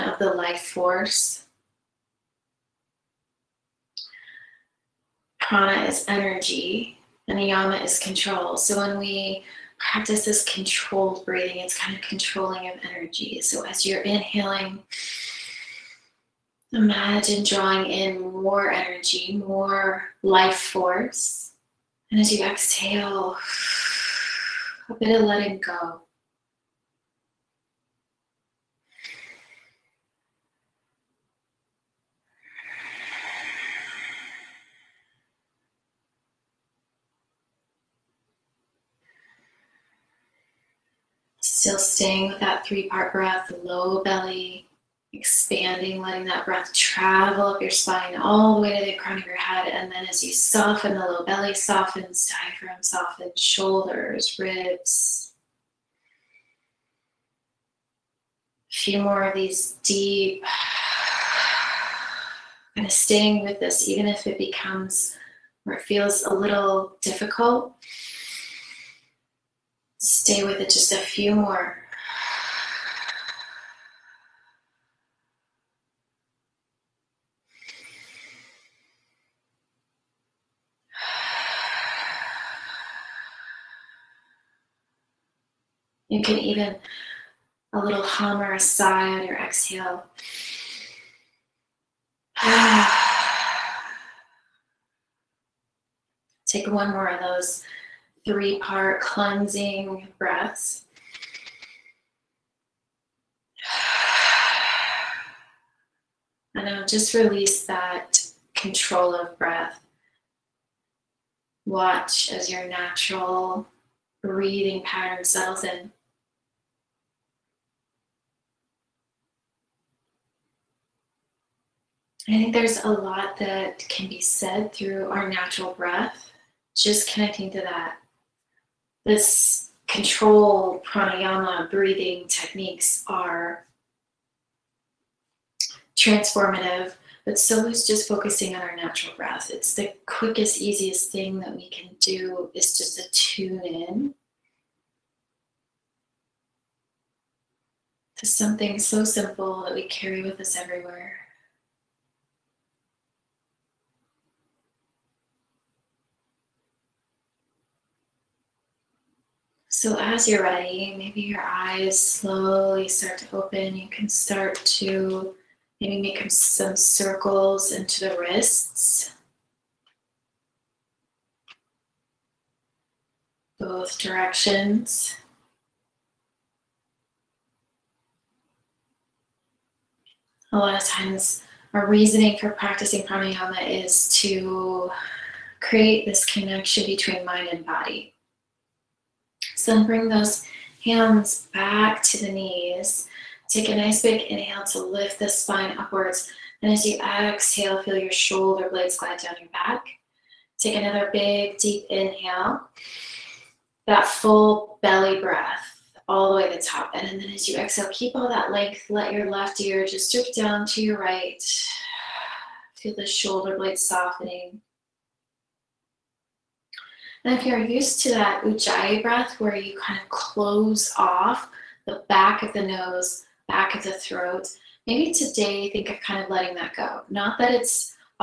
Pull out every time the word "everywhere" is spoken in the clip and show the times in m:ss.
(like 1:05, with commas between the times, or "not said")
2:30.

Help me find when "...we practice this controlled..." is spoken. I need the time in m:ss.
0:08.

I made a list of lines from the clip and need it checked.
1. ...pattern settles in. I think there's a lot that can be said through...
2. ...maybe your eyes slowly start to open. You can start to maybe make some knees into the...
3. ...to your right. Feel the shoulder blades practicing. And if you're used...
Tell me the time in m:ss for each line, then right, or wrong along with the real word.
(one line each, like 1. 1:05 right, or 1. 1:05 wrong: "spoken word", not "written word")
1. 1:54 right
2. 2:40 wrong: "circles", not "knees"
3. 3:30 wrong: "softening", not "practicing".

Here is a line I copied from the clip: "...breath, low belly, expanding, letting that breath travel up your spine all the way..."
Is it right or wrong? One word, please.
right.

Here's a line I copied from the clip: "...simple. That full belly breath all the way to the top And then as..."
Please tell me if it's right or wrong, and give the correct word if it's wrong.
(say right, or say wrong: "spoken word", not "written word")
wrong: "inhale", not "simple".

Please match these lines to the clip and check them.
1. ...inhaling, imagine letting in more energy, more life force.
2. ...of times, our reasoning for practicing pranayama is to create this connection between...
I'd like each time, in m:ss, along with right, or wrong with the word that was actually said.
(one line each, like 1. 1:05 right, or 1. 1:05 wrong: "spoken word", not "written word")
1. 0:14 wrong: "drawing", not "letting"
2. 3:00 right.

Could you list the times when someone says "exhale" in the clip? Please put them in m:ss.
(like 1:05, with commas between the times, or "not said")
0:22, 1:29, 3:16, 3:27.